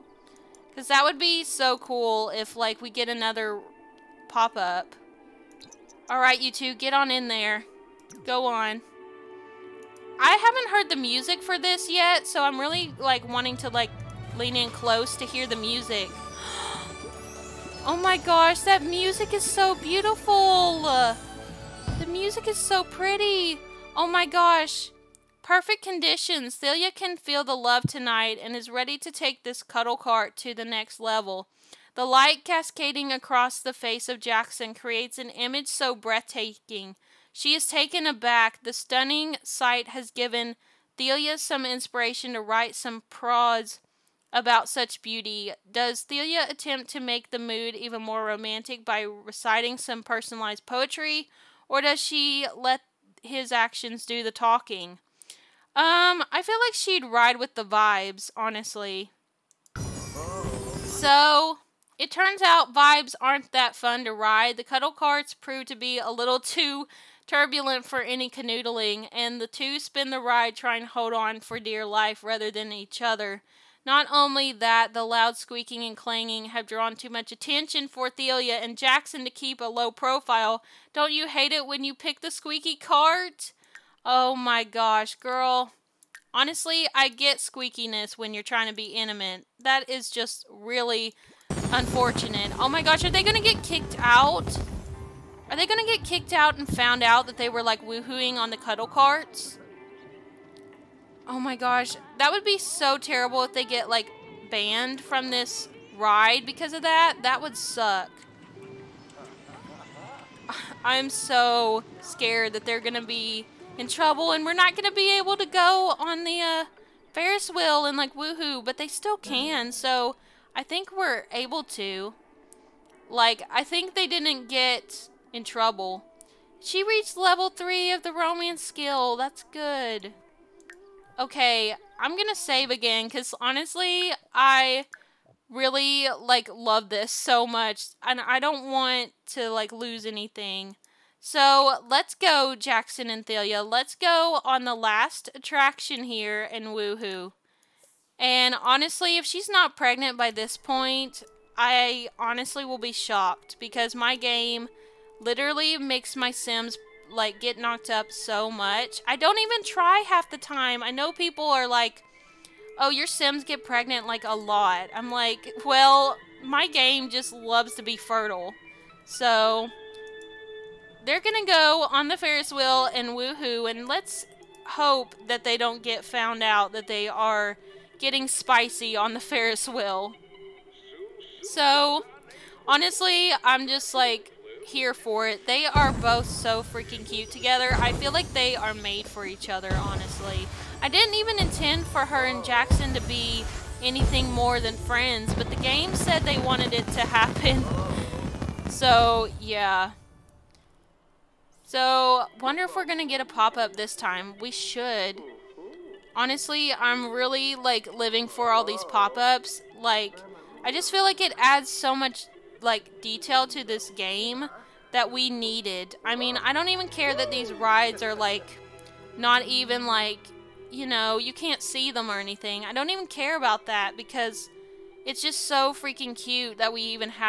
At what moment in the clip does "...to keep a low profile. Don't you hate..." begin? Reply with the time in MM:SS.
01:19.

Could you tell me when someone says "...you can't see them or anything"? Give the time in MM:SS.
03:41.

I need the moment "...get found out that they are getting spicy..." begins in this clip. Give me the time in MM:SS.
02:55.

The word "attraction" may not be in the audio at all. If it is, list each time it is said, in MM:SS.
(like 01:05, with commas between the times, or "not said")
02:25.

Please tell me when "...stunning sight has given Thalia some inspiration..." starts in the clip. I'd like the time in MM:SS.
00:38.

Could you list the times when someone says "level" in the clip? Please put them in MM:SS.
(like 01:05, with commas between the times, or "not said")
00:30, 02:07.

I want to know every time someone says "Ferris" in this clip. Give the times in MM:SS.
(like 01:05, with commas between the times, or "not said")
01:57, 02:52, 02:59.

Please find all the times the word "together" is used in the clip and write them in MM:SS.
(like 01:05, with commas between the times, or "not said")
03:07.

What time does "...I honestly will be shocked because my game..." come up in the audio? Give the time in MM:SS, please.
02:31.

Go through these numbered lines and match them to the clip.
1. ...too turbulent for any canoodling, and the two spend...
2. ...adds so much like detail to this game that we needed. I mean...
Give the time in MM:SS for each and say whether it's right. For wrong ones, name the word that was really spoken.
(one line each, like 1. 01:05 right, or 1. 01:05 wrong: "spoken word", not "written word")
1. 01:06 right
2. 03:31 right.